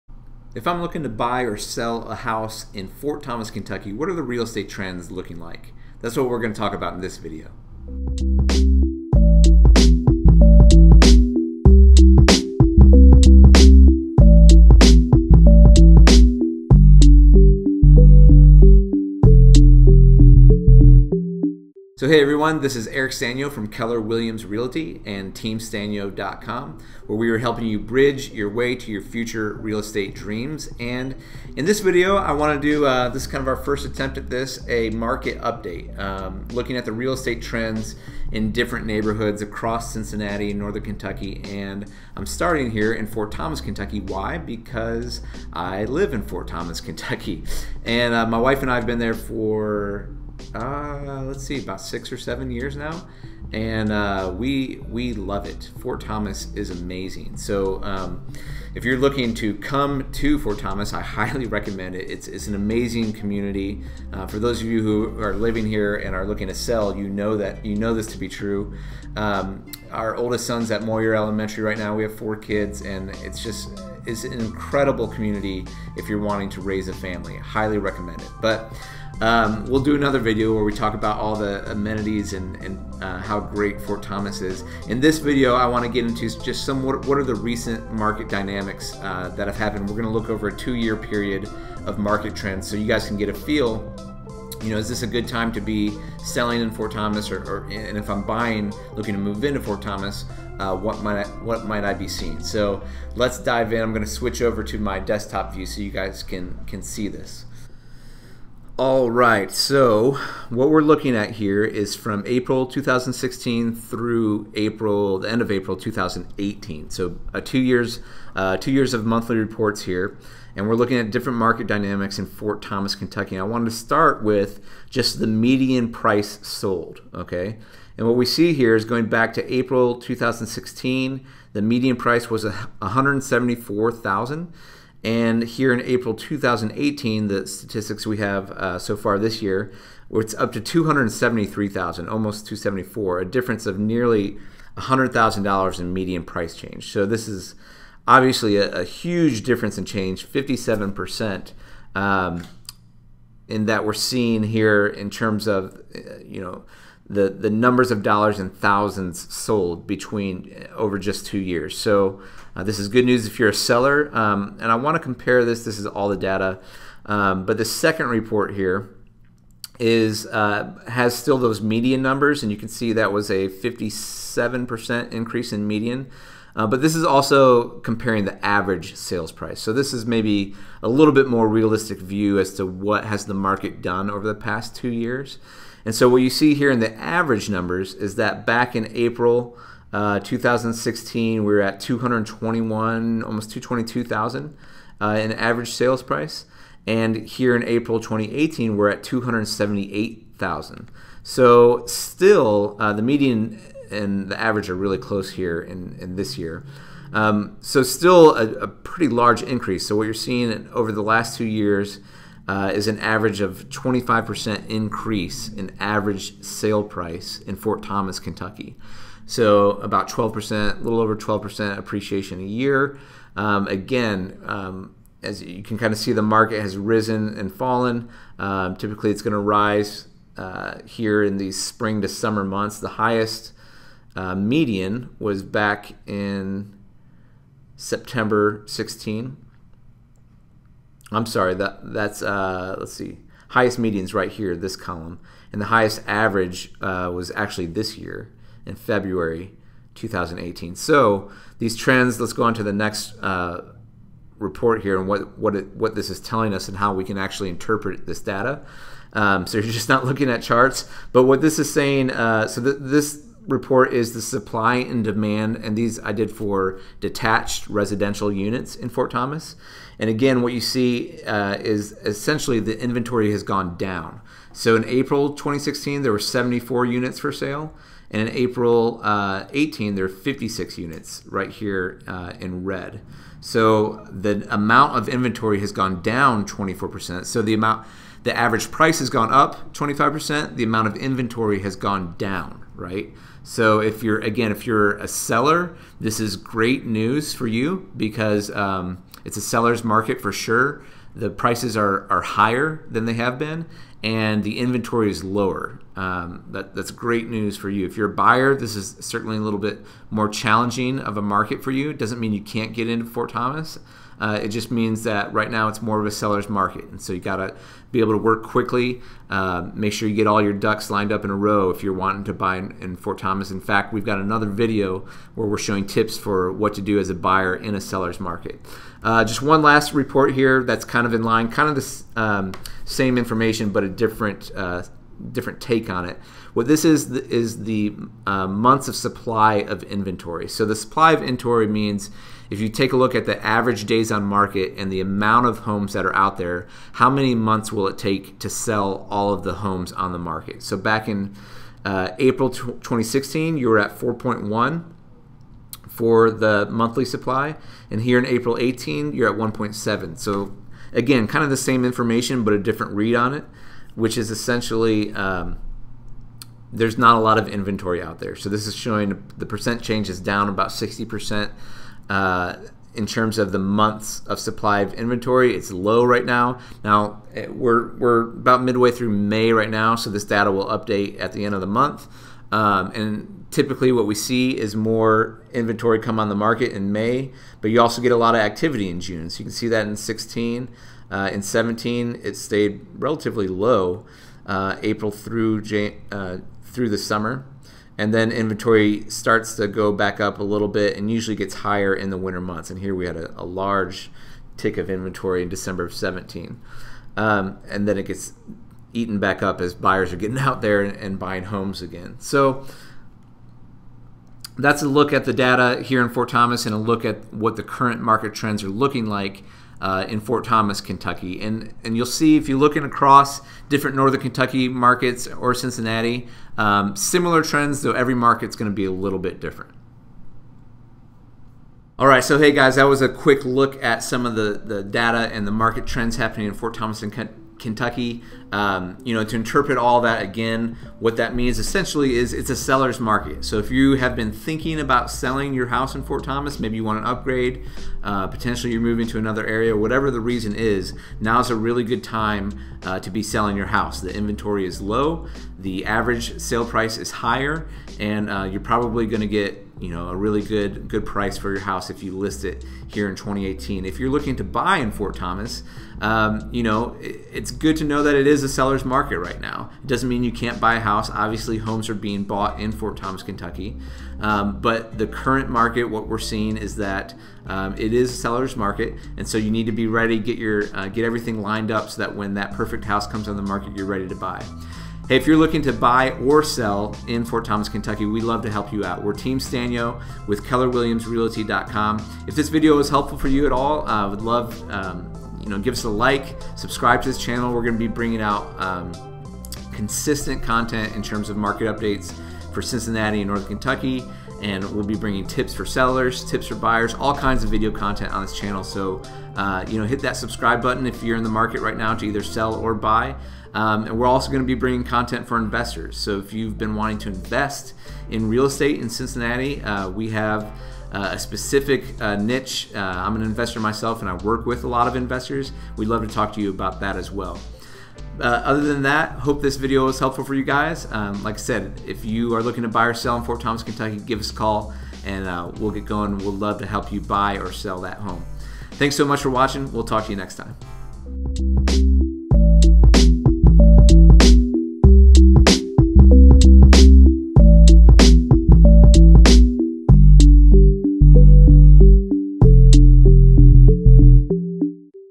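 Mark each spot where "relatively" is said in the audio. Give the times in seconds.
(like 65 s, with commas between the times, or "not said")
392 s.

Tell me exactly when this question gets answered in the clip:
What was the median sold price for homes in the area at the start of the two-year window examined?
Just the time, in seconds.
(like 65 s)
132 s.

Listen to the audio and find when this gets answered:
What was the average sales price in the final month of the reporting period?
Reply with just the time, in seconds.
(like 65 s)
199 s.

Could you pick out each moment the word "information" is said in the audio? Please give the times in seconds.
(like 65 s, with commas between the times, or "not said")
333 s, 361 s.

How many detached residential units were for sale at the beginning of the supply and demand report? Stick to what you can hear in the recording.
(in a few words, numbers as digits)
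74.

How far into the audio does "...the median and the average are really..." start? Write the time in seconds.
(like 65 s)
202 s.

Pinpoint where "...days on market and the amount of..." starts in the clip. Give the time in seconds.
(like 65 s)
343 s.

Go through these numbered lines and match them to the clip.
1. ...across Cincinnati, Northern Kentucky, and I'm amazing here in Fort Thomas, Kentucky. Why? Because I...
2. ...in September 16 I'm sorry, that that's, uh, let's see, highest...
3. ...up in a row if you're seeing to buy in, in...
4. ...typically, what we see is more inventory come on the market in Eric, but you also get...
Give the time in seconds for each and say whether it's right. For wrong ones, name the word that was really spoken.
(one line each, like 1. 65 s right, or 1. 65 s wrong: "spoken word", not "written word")
1. 39 s wrong: "starting", not "amazing"
2. 236 s right
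3. 321 s wrong: "wanting", not "seeing"
4. 383 s wrong: "May", not "Eric".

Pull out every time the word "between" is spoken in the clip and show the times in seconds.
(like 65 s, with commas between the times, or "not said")
159 s.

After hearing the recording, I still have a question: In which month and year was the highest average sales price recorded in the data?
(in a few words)
February 2018.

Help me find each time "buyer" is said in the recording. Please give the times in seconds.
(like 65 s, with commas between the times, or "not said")
308 s, 327 s, 409 s, 506 s.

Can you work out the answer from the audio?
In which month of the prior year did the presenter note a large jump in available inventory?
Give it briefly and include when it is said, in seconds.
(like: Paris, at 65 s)
December 2017, at 405 s.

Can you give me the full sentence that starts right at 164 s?
Um, and I want to compare this.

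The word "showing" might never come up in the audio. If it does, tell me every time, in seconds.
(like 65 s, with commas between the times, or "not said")
325 s, 368 s.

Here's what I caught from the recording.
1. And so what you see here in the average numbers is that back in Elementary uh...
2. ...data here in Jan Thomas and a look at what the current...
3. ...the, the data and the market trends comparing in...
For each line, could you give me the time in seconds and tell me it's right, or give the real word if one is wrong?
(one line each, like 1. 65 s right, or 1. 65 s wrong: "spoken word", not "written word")
1. 185 s wrong: "April", not "Elementary"
2. 415 s wrong: "Fort", not "Jan"
3. 434 s wrong: "happening", not "comparing".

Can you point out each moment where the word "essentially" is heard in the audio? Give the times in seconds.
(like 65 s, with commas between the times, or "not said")
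272 s, 364 s, 441 s.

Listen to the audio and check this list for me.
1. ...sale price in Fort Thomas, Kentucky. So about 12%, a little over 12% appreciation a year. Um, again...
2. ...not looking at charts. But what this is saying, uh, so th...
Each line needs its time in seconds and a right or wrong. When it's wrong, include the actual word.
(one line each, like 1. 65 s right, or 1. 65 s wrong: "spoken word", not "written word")
1. 216 s right
2. 259 s right.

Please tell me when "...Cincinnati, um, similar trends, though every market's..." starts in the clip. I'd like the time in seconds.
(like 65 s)
425 s.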